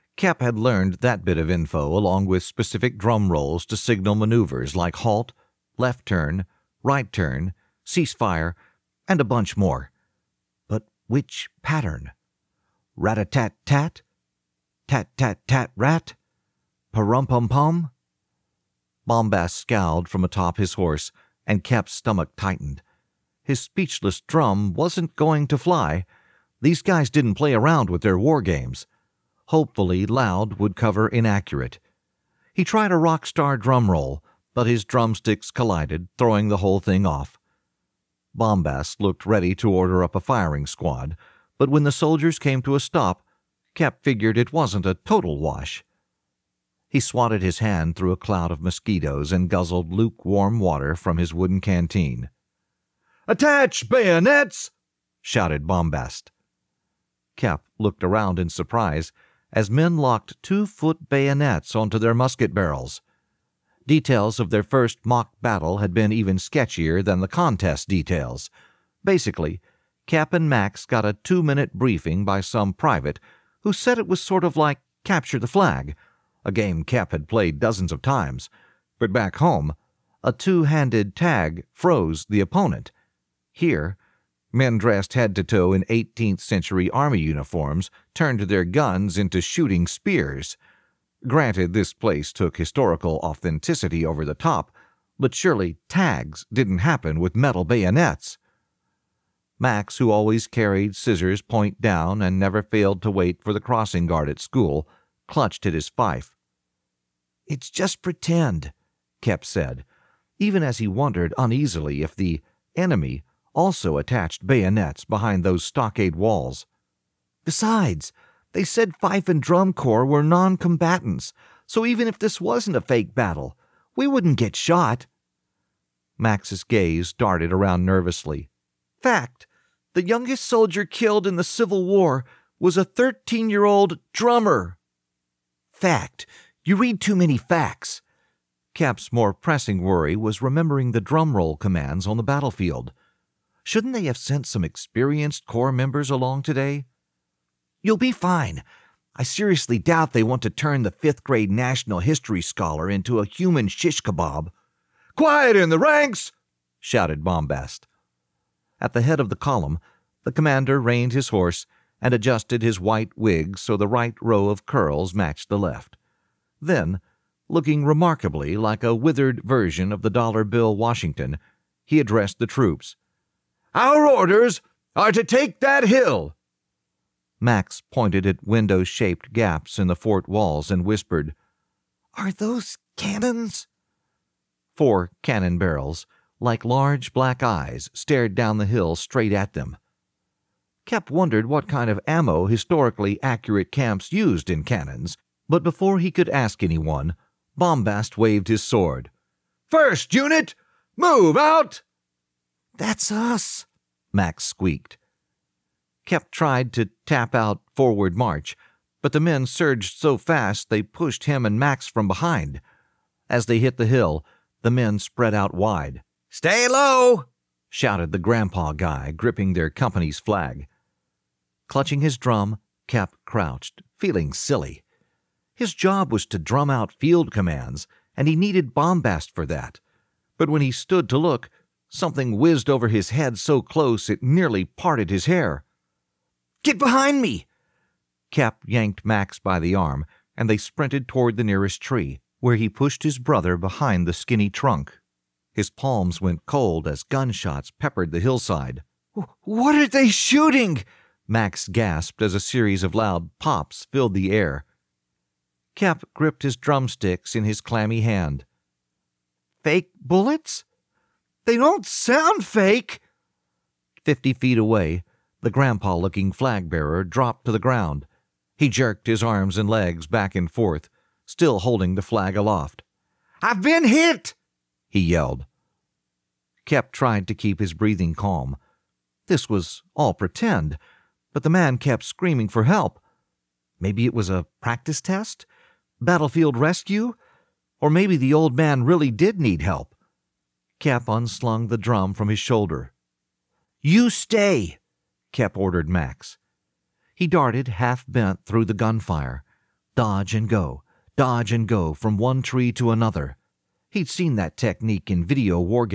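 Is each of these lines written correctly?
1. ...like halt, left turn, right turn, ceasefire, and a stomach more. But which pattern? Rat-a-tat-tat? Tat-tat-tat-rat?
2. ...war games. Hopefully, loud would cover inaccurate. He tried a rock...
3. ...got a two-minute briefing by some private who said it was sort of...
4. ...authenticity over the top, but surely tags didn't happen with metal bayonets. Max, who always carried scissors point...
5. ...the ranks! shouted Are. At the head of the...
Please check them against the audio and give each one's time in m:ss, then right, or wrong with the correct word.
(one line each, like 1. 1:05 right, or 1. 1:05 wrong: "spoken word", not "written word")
1. 0:04 wrong: "bunch", not "stomach"
2. 0:28 right
3. 1:10 right
4. 1:33 right
5. 2:35 wrong: "Bombast", not "Are".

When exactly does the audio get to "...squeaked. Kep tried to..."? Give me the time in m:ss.
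3:24.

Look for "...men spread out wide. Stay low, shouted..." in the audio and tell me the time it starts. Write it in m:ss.
3:34.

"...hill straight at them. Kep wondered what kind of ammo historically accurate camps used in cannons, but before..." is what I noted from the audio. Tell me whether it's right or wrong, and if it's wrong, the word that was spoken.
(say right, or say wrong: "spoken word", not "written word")
right.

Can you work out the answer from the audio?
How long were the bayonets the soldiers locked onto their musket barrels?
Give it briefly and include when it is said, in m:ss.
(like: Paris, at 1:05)
2 feet, at 1:00.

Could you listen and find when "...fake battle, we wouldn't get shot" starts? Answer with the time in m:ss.
2:02.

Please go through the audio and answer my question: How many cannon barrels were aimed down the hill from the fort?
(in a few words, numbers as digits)
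4.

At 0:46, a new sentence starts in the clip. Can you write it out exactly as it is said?
He swatted his hand through a cloud of mosquitoes and guzzled lukewarm water from his wooden canteen.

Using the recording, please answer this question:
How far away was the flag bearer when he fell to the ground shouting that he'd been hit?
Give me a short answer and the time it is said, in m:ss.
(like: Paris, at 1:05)
50 feet, at 4:24.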